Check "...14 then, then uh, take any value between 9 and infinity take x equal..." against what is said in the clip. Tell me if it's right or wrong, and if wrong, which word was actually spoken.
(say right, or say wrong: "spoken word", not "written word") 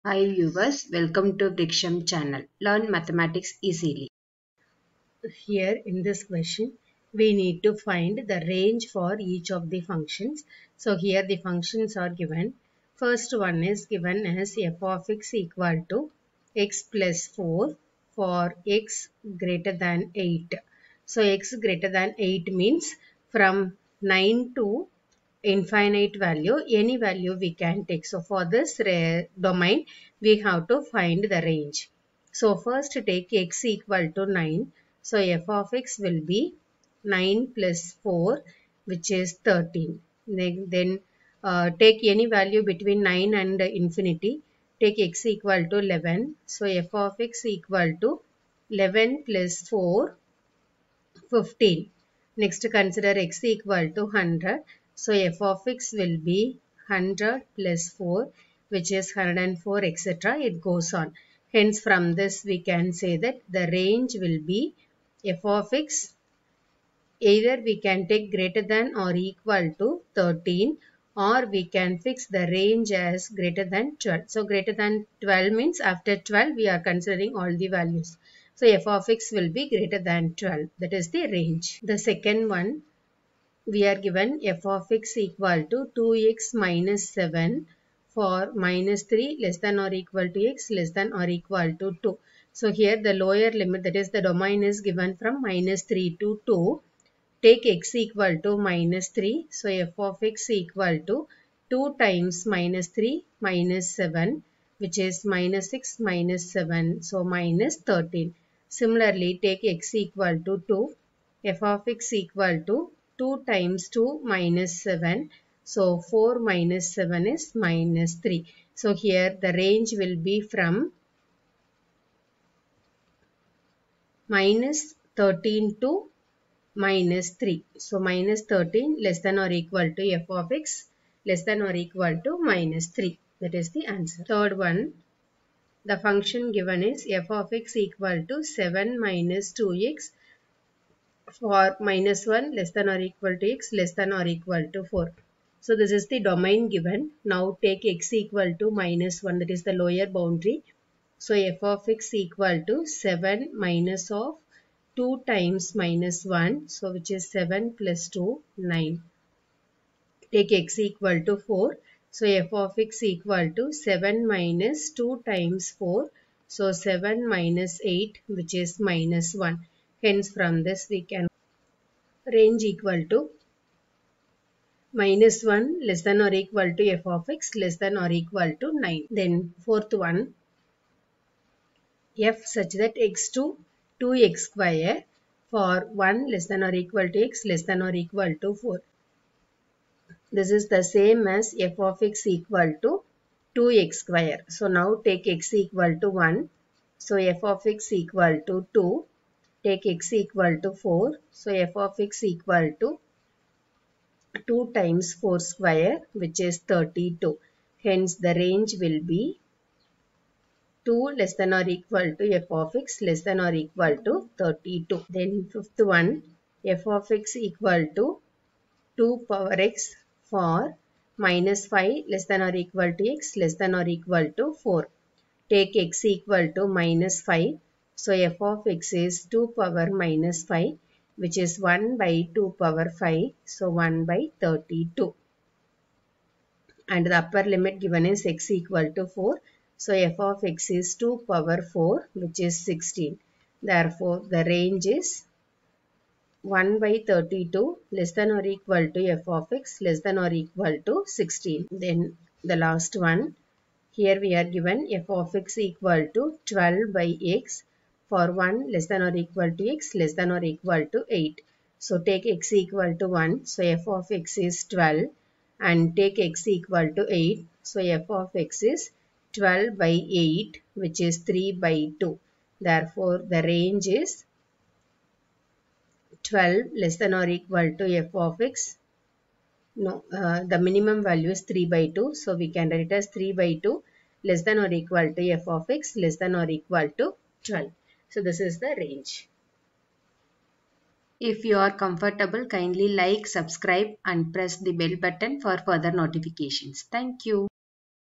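wrong: "13", not "14".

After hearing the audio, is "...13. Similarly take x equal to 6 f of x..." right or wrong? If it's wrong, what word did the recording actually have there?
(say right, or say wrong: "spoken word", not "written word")
wrong: "2", not "6".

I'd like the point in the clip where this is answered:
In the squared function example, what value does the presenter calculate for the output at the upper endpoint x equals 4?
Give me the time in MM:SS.
03:26.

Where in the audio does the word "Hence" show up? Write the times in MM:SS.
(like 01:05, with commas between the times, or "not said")
01:01, 02:50, 03:27.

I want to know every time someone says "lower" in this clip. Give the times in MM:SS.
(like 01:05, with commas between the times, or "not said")
01:33, 02:29.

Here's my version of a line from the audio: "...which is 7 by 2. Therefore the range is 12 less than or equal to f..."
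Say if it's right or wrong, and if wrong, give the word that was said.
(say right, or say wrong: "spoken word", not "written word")
wrong: "3", not "7".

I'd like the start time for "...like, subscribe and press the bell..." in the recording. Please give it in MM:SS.
04:52.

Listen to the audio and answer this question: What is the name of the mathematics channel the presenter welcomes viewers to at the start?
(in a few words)
Vriksham.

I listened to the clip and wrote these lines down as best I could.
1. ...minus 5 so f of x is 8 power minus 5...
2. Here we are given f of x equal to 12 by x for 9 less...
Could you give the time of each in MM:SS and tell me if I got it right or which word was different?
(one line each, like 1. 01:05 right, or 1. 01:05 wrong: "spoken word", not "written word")
1. 03:46 wrong: "2", not "8"
2. 04:13 wrong: "1", not "9".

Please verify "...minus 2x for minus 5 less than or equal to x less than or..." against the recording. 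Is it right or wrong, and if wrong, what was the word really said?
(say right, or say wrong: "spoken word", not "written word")
wrong: "1", not "5".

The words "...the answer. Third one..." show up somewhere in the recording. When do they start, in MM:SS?
02:13.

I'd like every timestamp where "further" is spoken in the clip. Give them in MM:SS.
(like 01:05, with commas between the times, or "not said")
04:55.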